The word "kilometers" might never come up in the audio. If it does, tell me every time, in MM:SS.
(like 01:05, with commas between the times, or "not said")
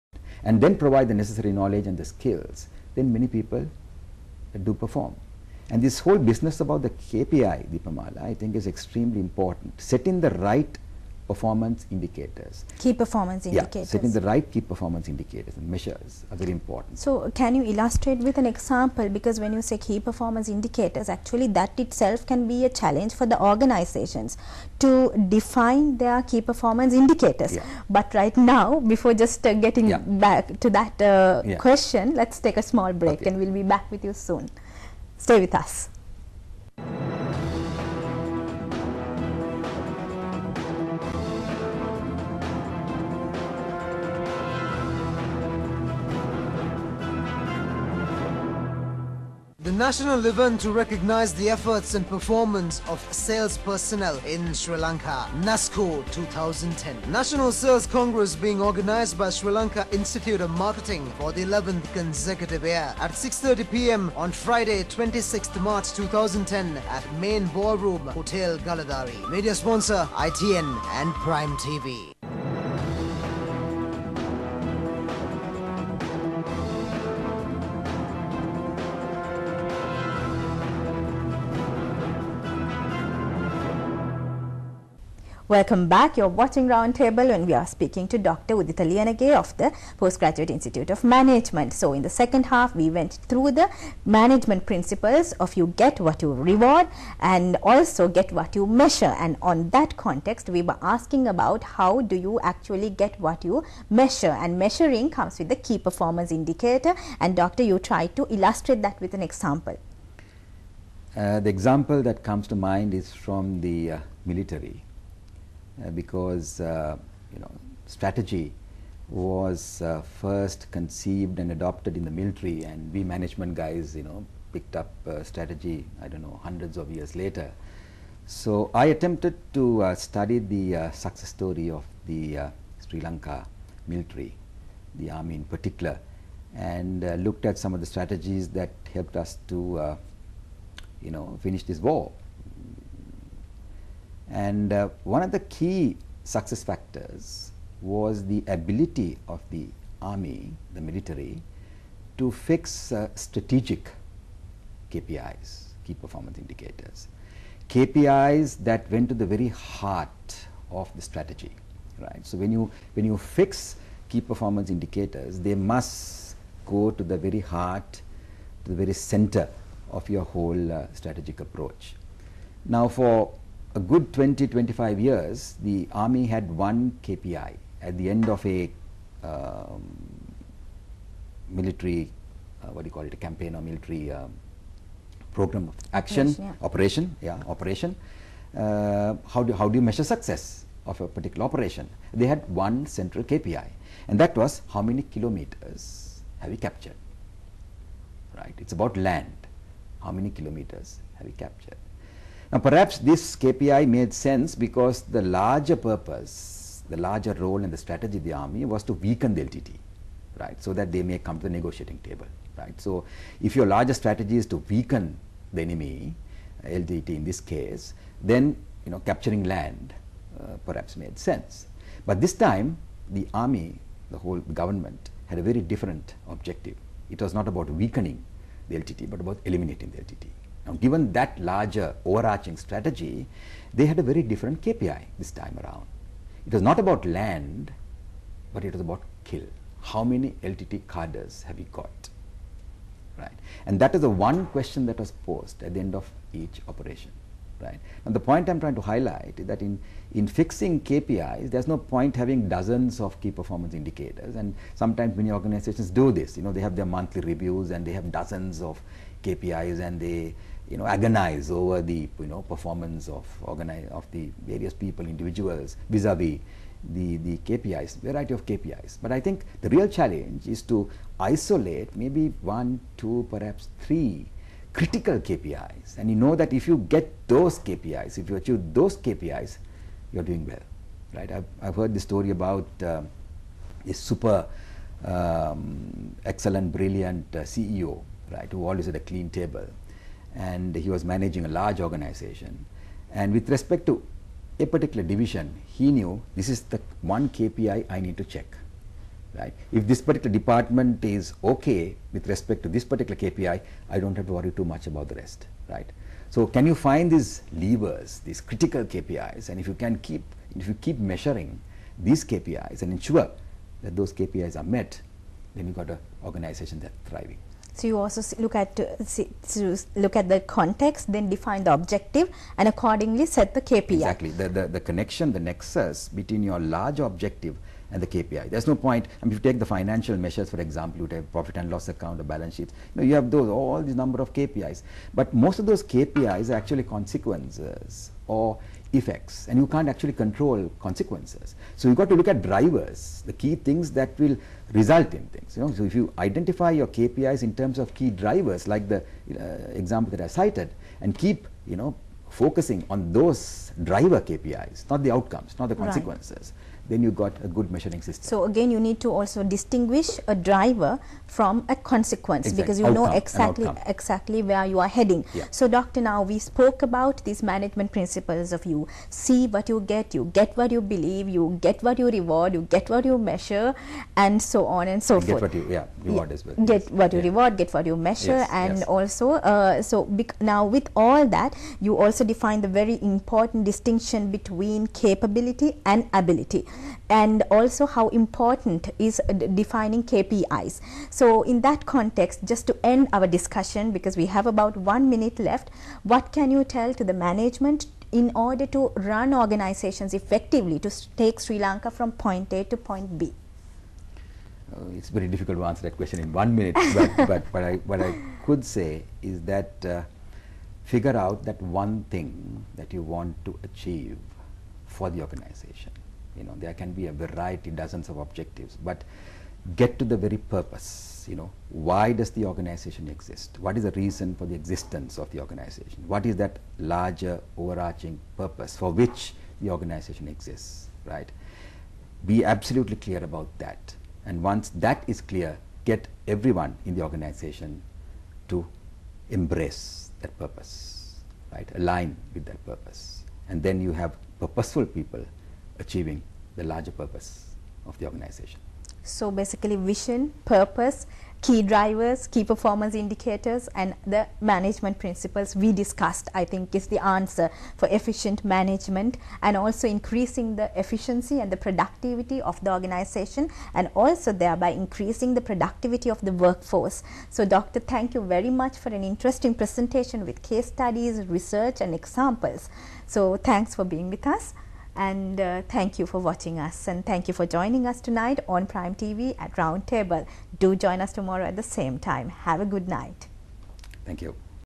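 03:15, 03:20.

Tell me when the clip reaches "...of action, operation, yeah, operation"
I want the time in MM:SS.
03:05.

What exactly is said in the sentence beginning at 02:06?
I don't know, hundreds of years later.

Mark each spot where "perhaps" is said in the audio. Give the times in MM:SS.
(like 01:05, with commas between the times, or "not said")
03:22, 03:40, 04:33.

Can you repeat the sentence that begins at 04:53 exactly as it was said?
And with respect to a particular division, he knew this is the one KPI I need to check.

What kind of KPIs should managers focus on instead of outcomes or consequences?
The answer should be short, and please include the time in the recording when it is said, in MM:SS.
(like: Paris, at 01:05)
driver KPIs, at 05:53.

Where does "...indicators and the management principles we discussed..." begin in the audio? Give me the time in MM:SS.
07:32.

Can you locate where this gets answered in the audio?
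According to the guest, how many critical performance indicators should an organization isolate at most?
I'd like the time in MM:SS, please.
04:33.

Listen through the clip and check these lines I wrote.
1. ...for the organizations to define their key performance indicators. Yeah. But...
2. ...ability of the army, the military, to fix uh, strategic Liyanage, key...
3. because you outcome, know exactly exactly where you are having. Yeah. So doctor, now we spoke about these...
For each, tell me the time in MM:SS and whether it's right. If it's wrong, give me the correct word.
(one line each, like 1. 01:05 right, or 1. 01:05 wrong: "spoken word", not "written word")
1. 00:23 right
2. 02:28 wrong: "KPIs", not "Liyanage"
3. 06:02 wrong: "heading", not "having".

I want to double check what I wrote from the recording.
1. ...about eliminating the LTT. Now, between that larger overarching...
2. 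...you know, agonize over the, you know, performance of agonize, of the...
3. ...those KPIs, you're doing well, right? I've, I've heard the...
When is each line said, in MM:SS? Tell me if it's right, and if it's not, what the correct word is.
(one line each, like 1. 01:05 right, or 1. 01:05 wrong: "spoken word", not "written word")
1. 03:49 wrong: "given", not "between"
2. 04:20 wrong: "organize", not "agonize"
3. 04:38 right.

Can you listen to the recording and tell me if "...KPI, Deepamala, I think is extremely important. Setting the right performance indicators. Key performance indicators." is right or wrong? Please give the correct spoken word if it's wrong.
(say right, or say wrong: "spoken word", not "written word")
right.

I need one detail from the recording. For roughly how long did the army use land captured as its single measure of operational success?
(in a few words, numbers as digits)
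20 to 25 years.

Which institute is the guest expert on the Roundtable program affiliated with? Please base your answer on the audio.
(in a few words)
Postgraduate Institute of Management.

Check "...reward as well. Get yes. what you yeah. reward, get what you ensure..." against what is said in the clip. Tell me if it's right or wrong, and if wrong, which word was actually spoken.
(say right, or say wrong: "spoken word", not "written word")
wrong: "measure", not "ensure".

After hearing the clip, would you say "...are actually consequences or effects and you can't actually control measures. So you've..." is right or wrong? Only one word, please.
wrong.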